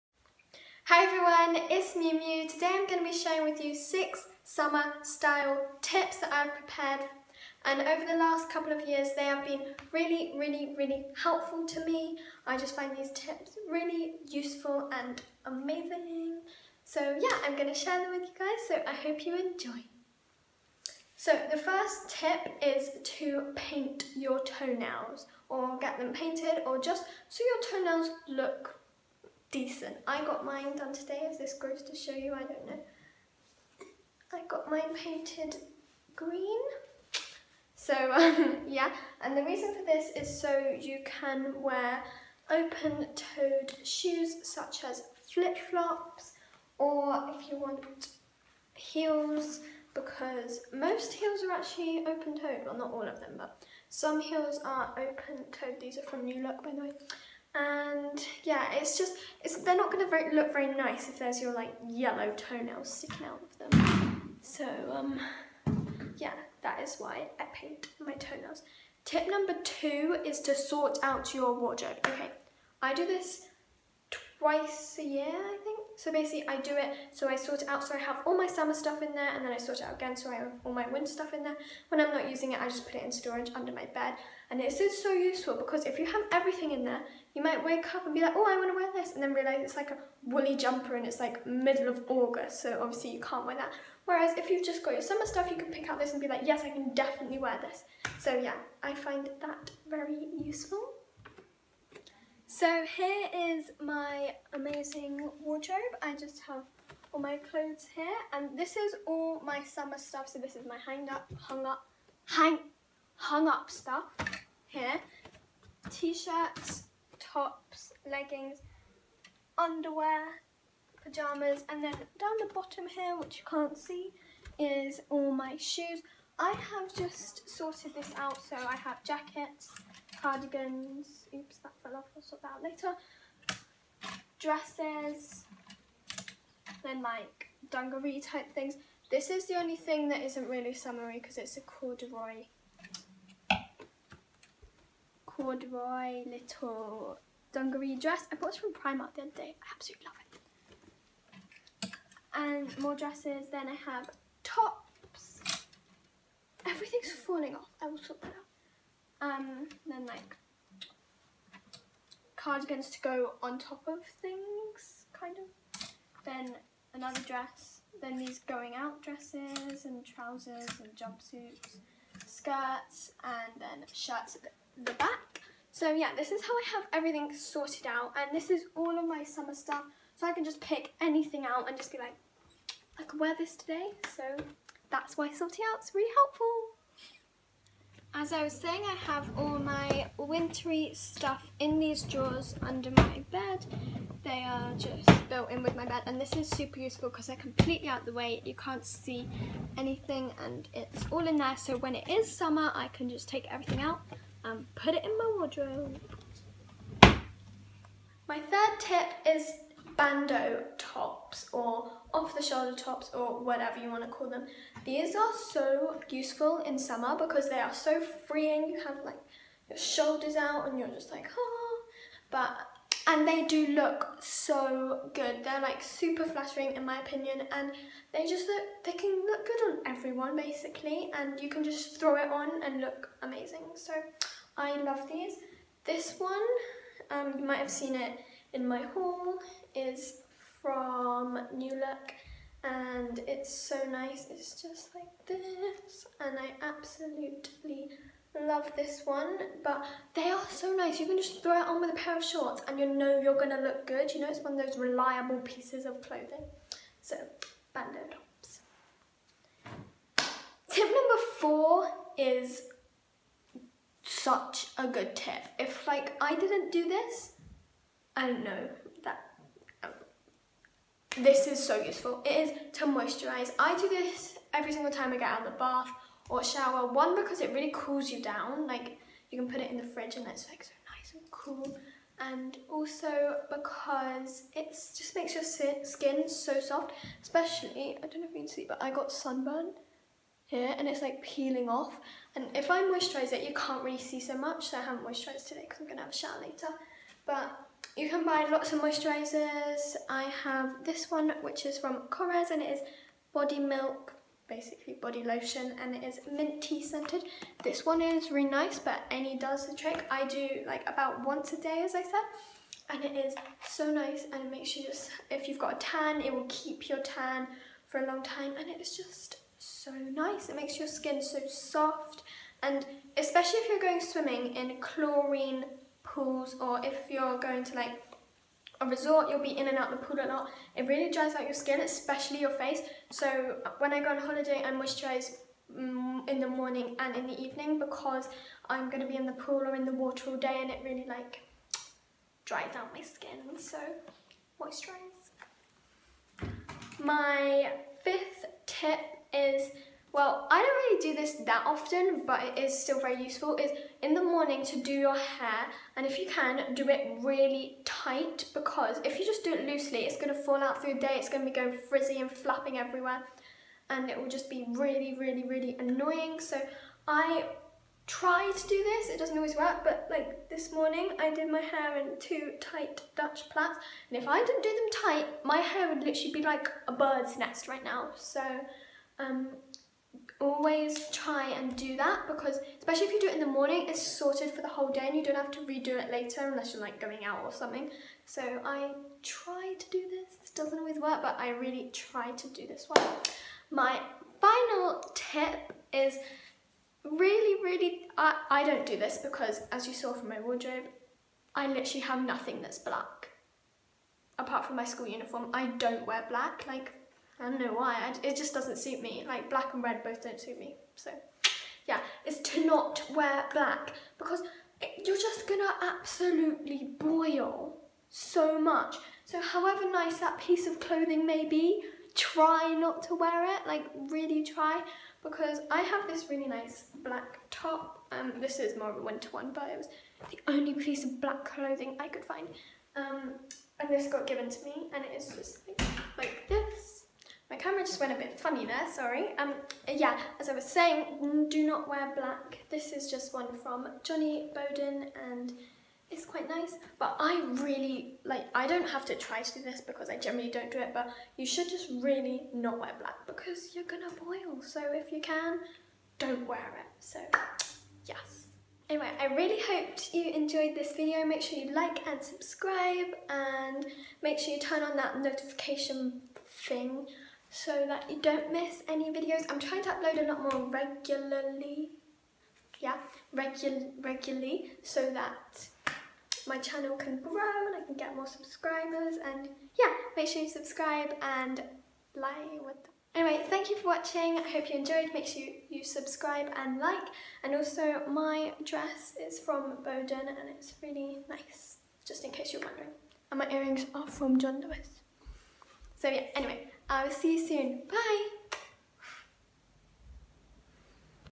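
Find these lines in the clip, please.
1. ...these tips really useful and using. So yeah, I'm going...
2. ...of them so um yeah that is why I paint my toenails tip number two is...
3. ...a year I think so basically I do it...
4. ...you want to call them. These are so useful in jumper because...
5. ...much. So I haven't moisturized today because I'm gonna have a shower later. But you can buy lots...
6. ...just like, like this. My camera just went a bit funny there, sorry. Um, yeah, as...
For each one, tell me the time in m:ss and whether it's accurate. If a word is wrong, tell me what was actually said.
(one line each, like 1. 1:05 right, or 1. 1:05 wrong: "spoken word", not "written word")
1. 0:12 wrong: "amazing", not "using"
2. 1:03 right
3. 1:14 right
4. 3:33 wrong: "summer", not "jumper"
5. 4:54 right
6. 7:15 right.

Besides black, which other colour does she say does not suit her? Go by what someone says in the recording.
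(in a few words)
Red.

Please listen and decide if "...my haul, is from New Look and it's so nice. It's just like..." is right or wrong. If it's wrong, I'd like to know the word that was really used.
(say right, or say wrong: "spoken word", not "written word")
right.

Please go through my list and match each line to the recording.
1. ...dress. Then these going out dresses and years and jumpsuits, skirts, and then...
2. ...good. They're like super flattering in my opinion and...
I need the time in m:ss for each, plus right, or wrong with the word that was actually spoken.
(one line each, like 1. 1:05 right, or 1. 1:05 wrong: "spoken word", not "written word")
1. 2:47 wrong: "trousers", not "years"
2. 3:45 right.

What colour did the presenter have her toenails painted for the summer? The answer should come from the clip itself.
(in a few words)
Green.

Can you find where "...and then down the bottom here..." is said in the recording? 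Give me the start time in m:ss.
2:01.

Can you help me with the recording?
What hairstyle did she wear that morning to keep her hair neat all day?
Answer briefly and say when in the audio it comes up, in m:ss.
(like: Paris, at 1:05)
Two tight Dutch plaits, at 6:12.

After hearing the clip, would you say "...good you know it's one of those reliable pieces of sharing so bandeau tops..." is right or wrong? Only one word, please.
wrong.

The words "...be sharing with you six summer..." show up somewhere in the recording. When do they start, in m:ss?
0:03.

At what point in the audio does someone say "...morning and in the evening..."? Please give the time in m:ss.
5:36.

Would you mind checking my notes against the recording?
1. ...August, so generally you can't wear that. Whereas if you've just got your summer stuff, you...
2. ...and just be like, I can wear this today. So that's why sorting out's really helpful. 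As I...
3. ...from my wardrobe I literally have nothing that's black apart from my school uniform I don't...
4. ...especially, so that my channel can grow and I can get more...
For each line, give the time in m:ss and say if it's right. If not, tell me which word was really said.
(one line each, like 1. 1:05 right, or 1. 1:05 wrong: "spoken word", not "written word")
1. 1:32 wrong: "obviously", not "generally"
2. 3:01 right
3. 6:40 right
4. 7:54 wrong: "regularly", not "especially".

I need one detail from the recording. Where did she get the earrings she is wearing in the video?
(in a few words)
John Lewis.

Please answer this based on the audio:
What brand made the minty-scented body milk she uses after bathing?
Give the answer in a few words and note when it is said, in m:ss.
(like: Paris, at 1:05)
Korres, at 5:02.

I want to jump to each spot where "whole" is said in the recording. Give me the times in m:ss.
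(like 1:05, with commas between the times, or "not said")
6:24.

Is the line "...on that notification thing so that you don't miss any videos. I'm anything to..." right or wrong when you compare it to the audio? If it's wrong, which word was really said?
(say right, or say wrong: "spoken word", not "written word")
wrong: "trying", not "anything".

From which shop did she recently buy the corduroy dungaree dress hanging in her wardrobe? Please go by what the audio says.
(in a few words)
Primark.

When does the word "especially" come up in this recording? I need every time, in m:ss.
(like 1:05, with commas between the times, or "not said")
4:47, 5:23, 5:31, 6:22.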